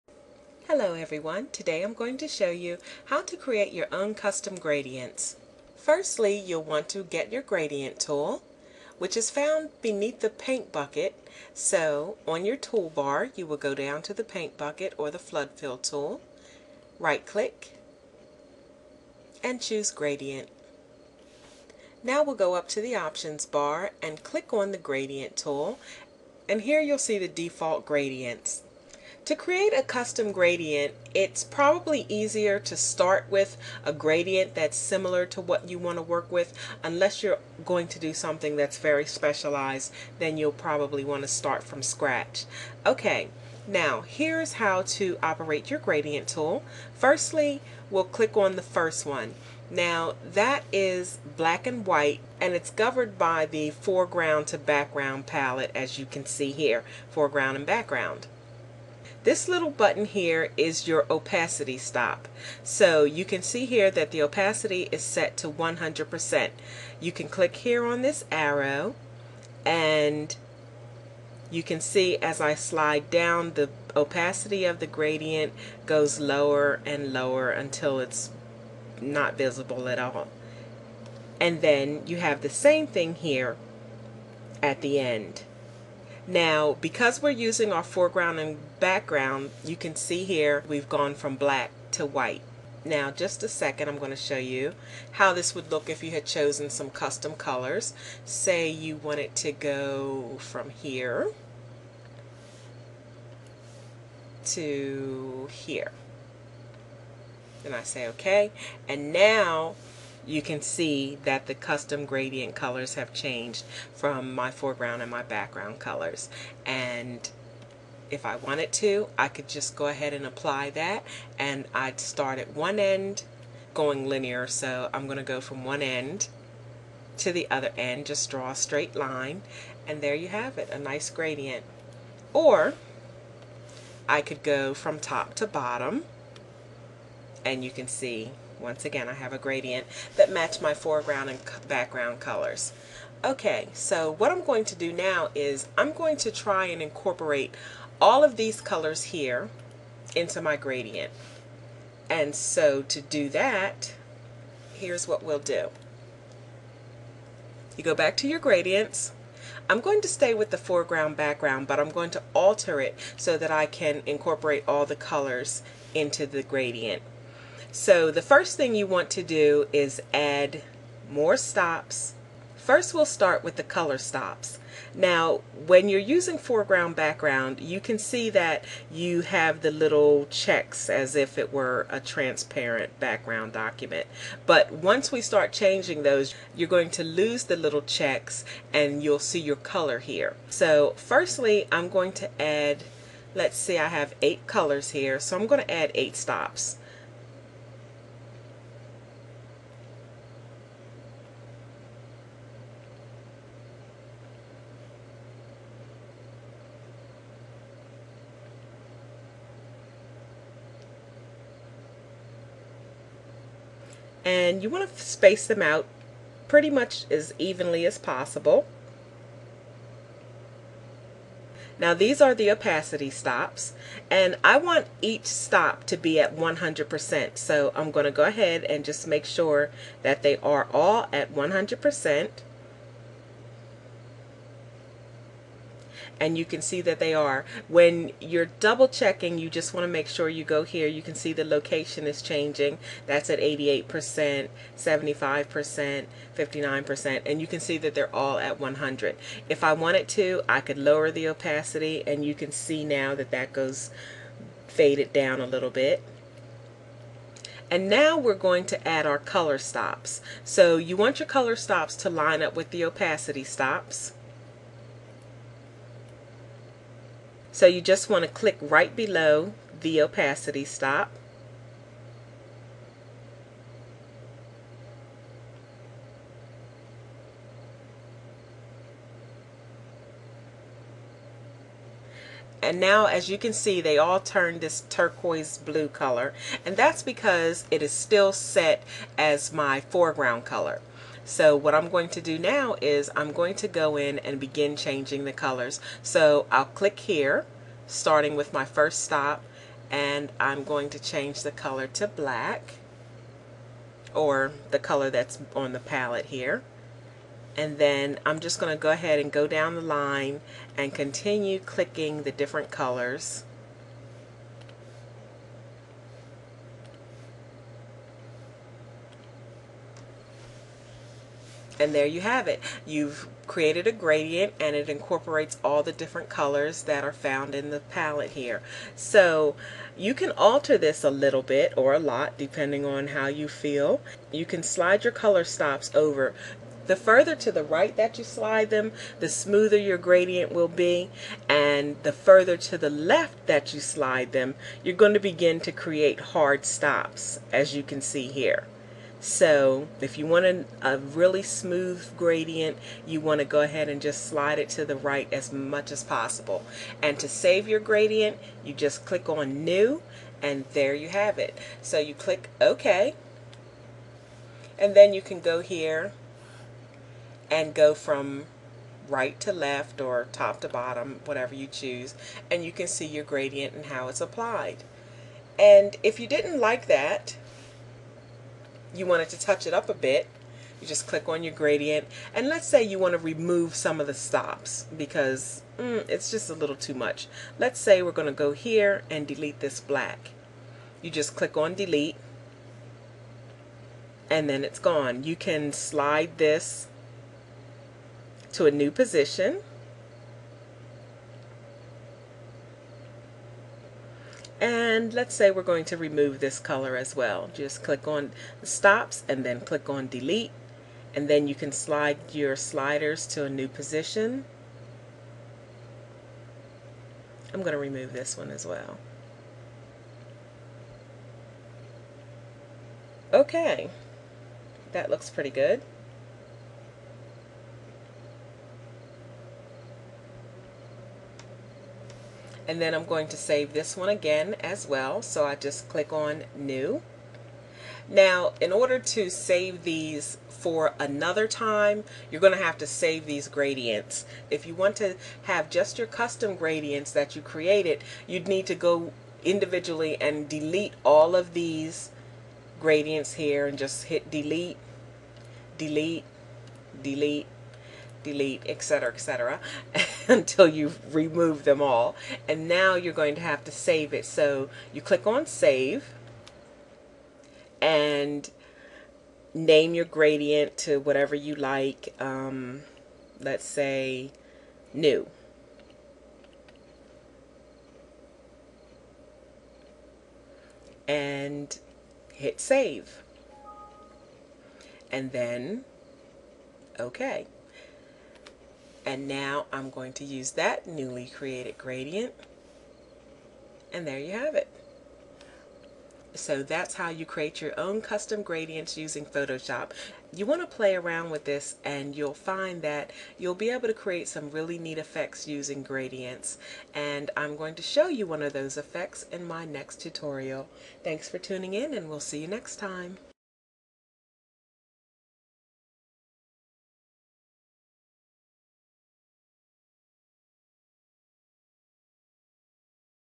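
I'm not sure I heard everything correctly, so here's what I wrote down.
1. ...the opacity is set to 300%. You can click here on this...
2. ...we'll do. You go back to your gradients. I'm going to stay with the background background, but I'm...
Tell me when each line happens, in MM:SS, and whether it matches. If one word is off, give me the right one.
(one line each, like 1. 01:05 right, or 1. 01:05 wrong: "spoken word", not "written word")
1. 01:04 wrong: "100", not "300"
2. 02:35 wrong: "foreground", not "background".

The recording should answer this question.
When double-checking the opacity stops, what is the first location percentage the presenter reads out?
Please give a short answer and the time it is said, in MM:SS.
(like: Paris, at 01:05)
88%, at 04:03.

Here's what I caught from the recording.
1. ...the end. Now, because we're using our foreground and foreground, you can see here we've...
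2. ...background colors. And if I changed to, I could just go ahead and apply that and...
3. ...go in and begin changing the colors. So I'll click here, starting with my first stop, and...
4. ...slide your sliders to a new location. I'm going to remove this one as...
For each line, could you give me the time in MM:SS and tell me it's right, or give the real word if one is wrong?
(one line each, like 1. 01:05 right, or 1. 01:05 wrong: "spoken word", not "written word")
1. 01:24 wrong: "background", not "foreground"
2. 01:55 wrong: "wanted", not "changed"
3. 04:53 right
4. 06:51 wrong: "position", not "location".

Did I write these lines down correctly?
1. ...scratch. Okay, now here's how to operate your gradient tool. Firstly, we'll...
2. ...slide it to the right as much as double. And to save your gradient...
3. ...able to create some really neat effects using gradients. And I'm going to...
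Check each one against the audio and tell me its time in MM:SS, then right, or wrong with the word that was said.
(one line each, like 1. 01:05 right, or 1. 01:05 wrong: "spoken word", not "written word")
1. 00:41 right
2. 05:54 wrong: "possible", not "double"
3. 08:23 right.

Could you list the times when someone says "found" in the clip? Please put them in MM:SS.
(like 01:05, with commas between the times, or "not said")
00:09, 05:27.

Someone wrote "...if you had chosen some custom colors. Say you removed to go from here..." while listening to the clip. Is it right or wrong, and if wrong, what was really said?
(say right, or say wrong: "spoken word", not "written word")
wrong: "wanted", not "removed".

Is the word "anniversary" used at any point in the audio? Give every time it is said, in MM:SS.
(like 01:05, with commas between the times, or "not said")
not said.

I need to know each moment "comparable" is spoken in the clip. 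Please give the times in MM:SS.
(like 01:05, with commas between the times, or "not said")
not said.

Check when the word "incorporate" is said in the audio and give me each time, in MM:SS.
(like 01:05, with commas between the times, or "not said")
02:26, 02:44, 05:24.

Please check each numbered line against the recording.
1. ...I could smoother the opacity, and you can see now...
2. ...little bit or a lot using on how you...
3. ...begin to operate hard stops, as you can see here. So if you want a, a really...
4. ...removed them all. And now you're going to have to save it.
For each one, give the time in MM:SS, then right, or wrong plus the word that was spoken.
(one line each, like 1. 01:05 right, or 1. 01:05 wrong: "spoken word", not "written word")
1. 04:10 wrong: "lower", not "smoother"
2. 05:31 wrong: "depending", not "using"
3. 05:45 wrong: "create", not "operate"
4. 07:41 right.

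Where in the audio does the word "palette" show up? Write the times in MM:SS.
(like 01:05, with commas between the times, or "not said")
00:55, 05:05, 05:27.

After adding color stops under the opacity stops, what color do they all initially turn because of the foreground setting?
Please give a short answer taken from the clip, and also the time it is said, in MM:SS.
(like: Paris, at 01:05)
Turquoise blue, at 04:44.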